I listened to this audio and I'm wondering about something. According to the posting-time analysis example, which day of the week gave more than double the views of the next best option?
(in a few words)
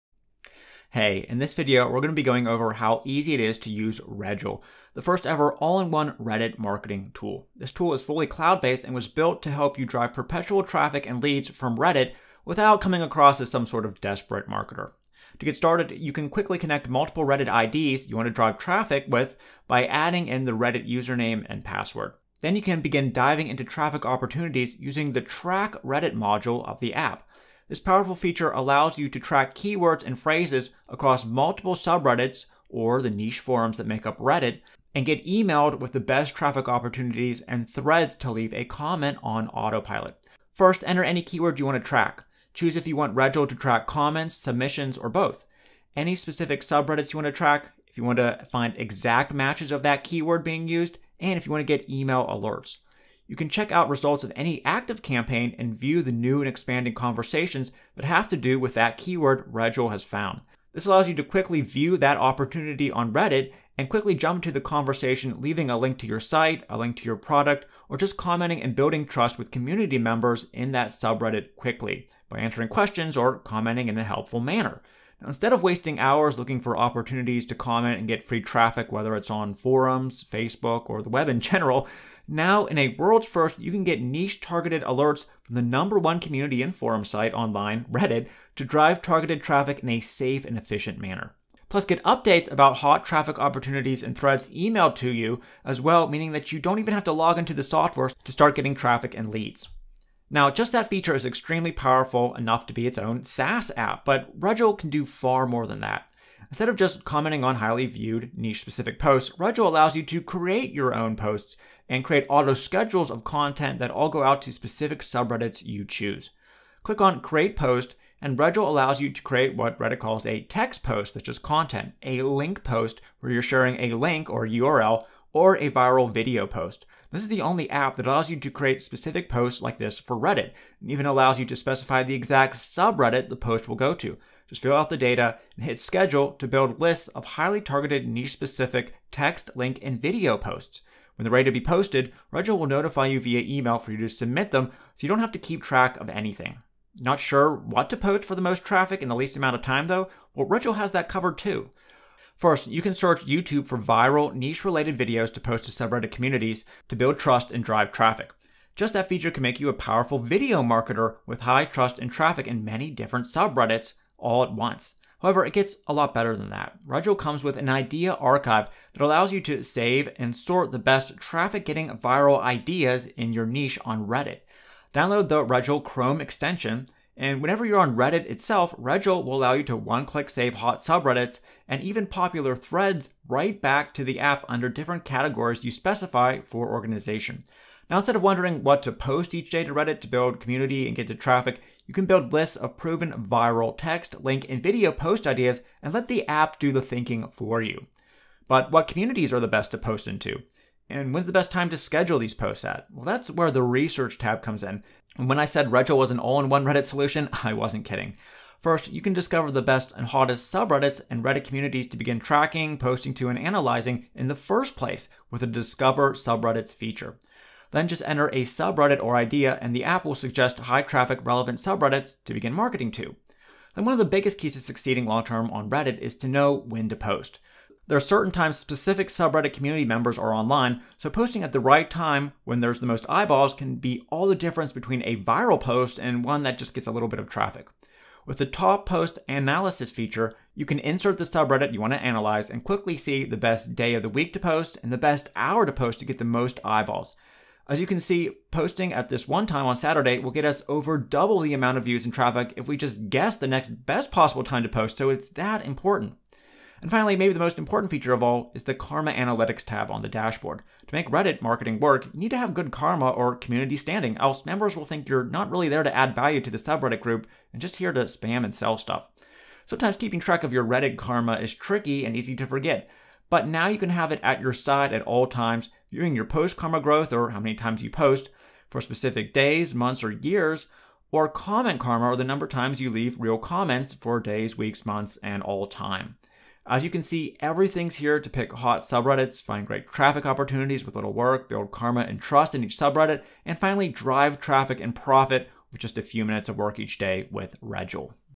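Saturday.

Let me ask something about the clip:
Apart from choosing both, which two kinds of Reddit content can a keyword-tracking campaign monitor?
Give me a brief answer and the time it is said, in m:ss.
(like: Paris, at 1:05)
comments, submissions, at 0:43.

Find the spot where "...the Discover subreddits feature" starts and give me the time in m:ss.
3:35.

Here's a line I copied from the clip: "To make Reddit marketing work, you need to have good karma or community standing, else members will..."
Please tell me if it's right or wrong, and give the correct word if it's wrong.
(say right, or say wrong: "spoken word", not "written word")
right.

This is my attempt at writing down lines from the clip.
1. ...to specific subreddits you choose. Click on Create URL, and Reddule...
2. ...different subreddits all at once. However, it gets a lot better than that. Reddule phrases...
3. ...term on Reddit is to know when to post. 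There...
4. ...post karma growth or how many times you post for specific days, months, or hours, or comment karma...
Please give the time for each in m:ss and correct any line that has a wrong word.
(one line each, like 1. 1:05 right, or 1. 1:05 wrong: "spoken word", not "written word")
1. 1:54 wrong: "Post", not "URL"
2. 2:42 wrong: "comes", not "phrases"
3. 3:45 right
4. 4:36 wrong: "years", not "hours".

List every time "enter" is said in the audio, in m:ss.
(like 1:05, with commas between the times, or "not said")
0:40, 3:38.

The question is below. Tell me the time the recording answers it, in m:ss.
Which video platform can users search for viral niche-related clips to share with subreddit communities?
2:33.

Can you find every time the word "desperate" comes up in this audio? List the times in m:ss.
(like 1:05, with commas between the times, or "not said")
0:14.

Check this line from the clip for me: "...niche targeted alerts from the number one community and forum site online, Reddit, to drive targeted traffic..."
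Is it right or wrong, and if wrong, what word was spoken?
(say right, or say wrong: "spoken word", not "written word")
right.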